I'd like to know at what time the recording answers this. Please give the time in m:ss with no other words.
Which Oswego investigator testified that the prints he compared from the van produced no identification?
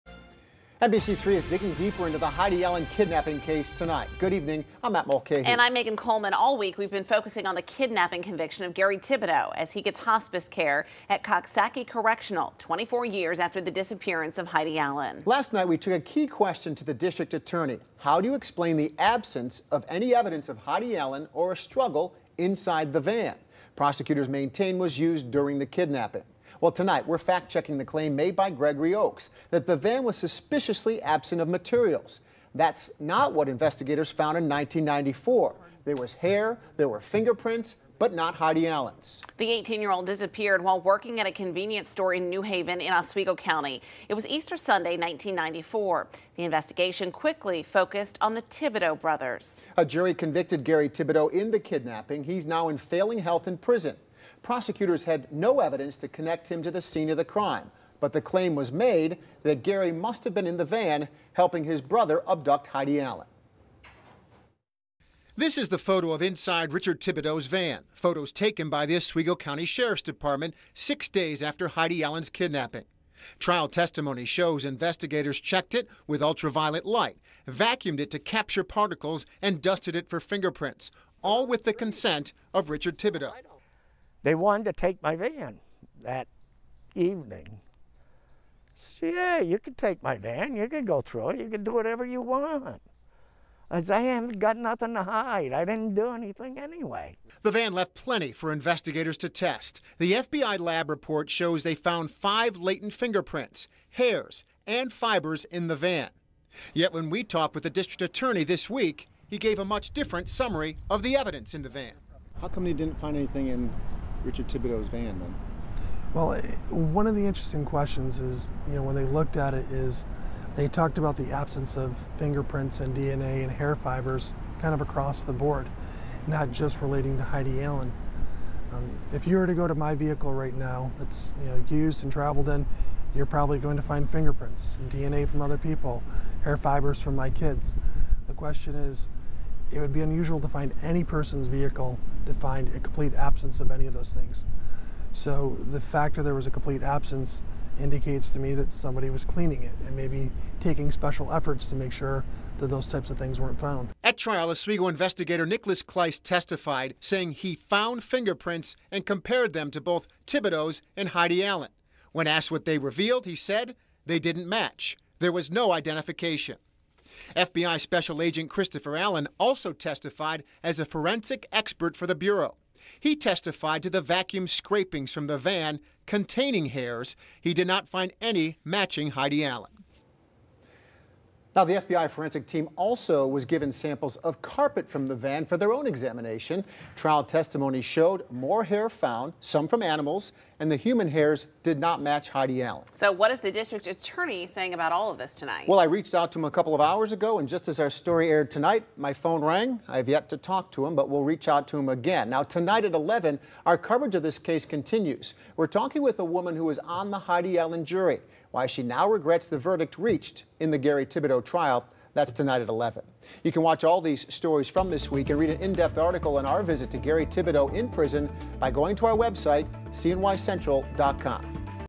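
2:35.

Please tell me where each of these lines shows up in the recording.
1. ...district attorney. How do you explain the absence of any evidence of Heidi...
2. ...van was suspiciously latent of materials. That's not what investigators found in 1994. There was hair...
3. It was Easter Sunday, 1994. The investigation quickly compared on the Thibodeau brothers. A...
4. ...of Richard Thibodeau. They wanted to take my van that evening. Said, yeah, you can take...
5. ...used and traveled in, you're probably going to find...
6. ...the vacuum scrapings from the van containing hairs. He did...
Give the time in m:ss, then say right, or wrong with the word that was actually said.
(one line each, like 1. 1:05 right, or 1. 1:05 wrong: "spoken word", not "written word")
1. 0:16 right
2. 0:29 wrong: "absent", not "latent"
3. 0:44 wrong: "focused", not "compared"
4. 1:22 right
5. 2:11 right
6. 2:53 right.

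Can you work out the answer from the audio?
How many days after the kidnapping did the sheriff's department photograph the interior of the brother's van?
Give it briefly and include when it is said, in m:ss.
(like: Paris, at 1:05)
6, at 1:10.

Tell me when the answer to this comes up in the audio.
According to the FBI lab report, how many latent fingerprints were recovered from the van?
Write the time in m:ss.
1:42.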